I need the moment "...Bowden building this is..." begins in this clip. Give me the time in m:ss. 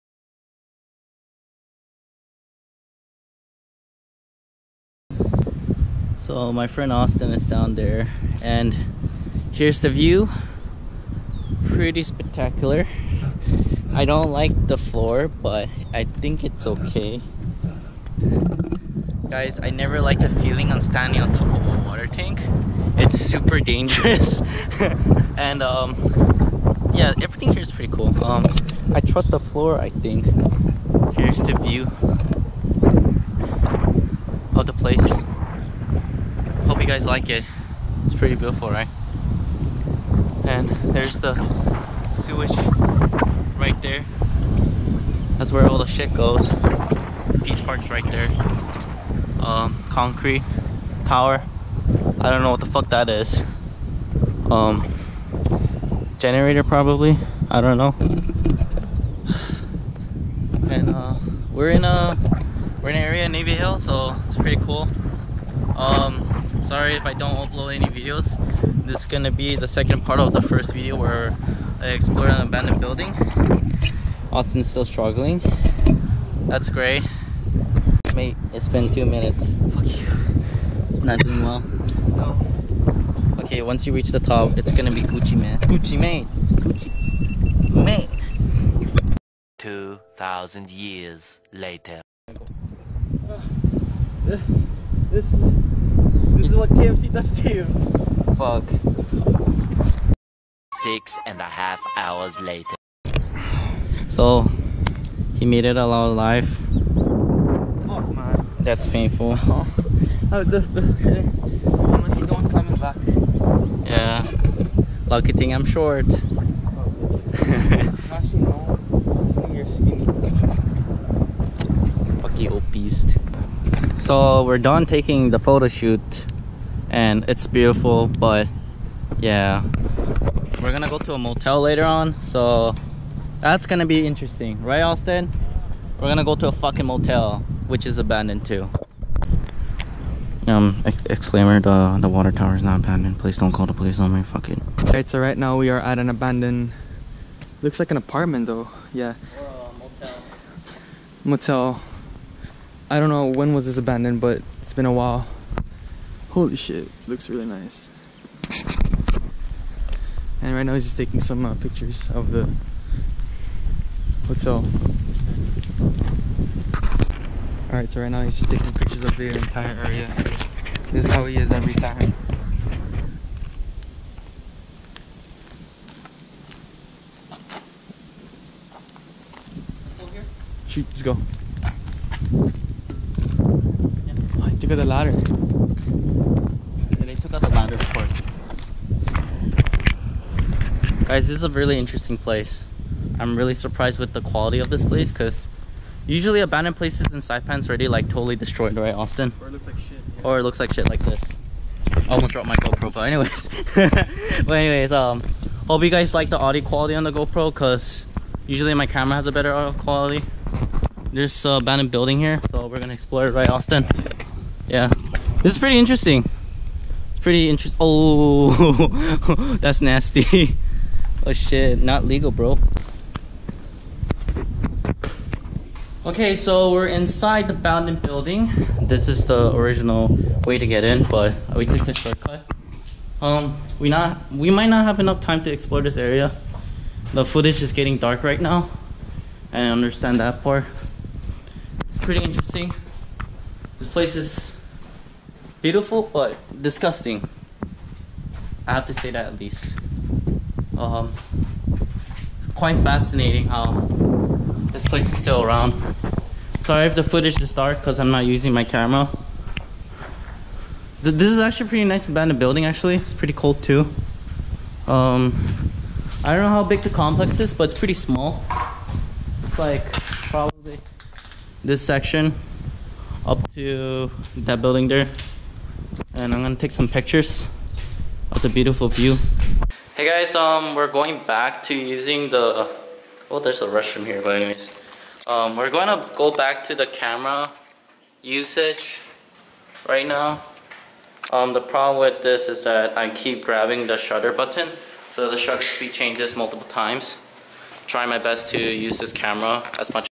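3:47.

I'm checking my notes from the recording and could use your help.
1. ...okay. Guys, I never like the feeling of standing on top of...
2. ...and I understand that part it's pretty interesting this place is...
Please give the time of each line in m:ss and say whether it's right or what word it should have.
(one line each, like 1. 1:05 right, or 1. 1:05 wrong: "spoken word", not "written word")
1. 0:16 right
2. 3:59 right.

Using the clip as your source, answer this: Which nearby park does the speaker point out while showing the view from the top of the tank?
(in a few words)
Peace Park.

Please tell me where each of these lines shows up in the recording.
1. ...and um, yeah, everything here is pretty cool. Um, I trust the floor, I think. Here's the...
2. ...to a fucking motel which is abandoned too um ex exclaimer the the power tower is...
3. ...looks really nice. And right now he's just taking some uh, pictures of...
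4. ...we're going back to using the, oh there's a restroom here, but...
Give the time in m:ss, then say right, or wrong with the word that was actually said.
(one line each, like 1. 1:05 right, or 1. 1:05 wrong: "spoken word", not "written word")
1. 0:25 right
2. 2:16 wrong: "water", not "power"
3. 2:37 right
4. 4:40 right.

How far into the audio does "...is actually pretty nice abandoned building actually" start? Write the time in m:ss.
4:21.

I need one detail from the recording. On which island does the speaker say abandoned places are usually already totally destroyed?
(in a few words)
Saipan.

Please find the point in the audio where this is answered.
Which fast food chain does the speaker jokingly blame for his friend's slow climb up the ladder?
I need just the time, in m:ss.
1:36.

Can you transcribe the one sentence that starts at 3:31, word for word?
There's an abandoned building here, so we're gonna explore it, right, Austin?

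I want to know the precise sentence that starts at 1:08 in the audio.
This is gonna be the second part of the first video where I explore an abandoned building.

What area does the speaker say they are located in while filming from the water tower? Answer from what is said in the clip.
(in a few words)
Navy Hill.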